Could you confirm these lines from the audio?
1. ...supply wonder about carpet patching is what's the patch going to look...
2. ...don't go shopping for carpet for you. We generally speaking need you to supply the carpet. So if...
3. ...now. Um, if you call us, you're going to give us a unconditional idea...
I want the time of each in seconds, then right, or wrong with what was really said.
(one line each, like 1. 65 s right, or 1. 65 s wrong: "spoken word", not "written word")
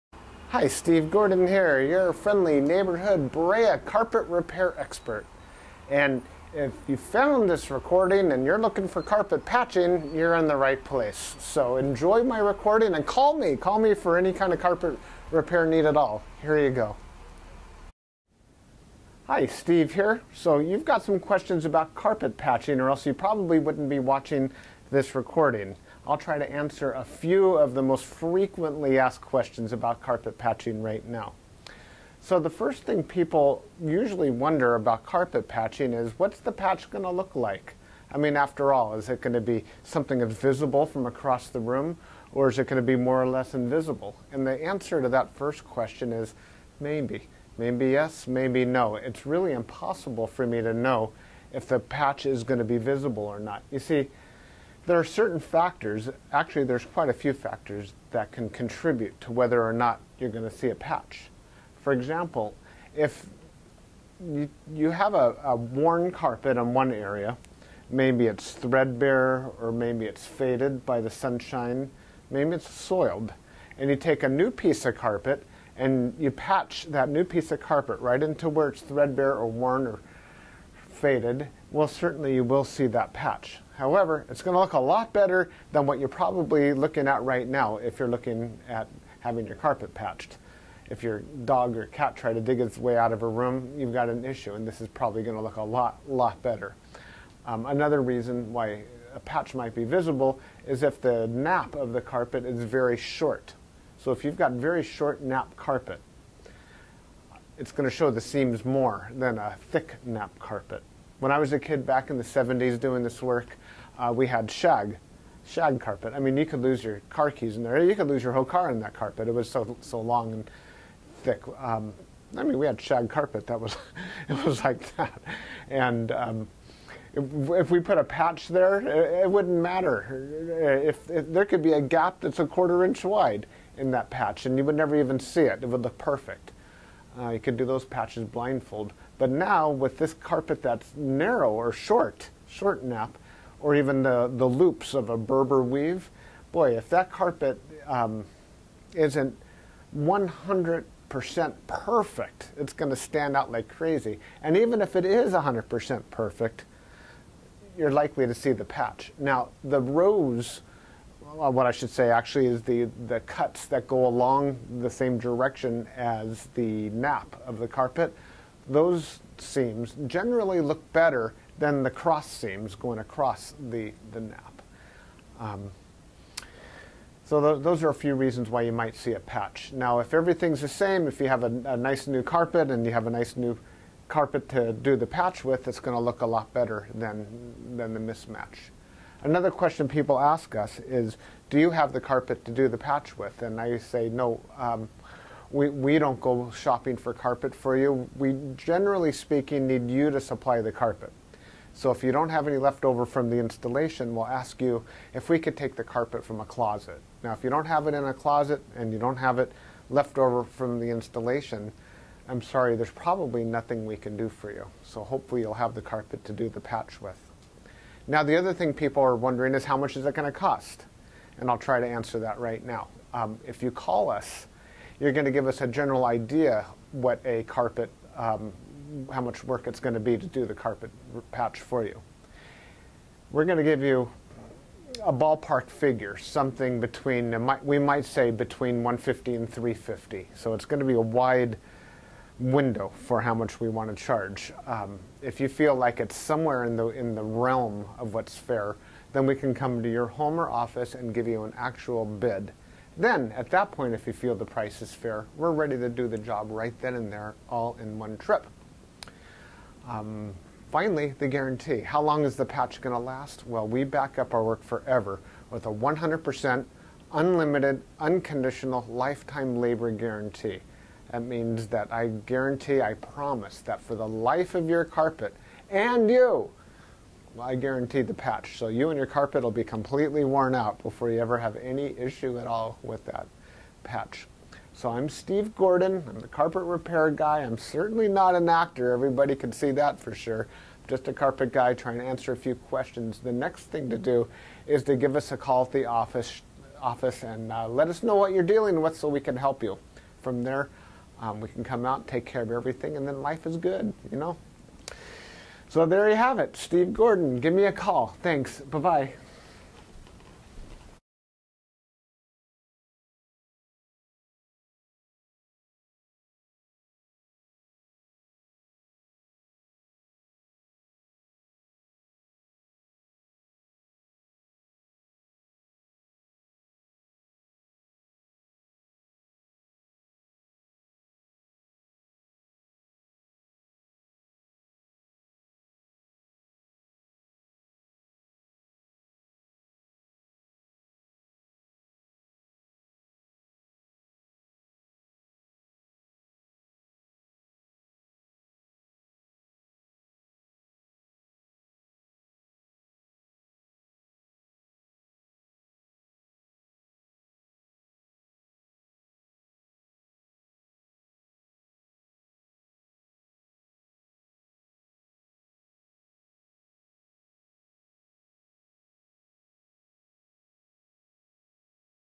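1. 33 s wrong: "usually", not "supply"
2. 195 s right
3. 222 s wrong: "general", not "unconditional".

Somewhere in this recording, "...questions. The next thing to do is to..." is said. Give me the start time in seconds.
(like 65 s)
292 s.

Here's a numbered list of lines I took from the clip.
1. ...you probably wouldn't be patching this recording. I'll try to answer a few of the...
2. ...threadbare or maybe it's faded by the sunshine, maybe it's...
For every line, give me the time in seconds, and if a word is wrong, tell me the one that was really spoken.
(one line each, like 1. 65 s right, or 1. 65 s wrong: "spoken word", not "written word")
1. 23 s wrong: "watching", not "patching"
2. 68 s right.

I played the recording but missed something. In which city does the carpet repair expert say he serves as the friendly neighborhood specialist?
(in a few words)
Brea.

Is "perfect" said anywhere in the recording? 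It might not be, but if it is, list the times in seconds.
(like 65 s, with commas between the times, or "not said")
135 s, 151 s, 156 s.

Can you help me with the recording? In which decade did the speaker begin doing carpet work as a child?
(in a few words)
The 70s.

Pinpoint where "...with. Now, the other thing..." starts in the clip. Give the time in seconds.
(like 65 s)
217 s.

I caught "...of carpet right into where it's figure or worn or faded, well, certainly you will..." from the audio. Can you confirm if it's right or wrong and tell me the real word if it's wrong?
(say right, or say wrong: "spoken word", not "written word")
wrong: "threadbare", not "figure".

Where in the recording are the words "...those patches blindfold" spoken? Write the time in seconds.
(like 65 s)
137 s.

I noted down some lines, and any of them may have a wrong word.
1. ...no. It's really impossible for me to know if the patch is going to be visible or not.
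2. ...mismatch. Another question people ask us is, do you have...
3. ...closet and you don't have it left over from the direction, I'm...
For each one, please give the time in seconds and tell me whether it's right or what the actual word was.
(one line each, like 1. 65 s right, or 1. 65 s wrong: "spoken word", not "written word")
1. 48 s right
2. 187 s right
3. 208 s wrong: "installation", not "direction".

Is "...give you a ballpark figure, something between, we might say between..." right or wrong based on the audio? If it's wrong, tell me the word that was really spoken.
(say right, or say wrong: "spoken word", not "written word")
right.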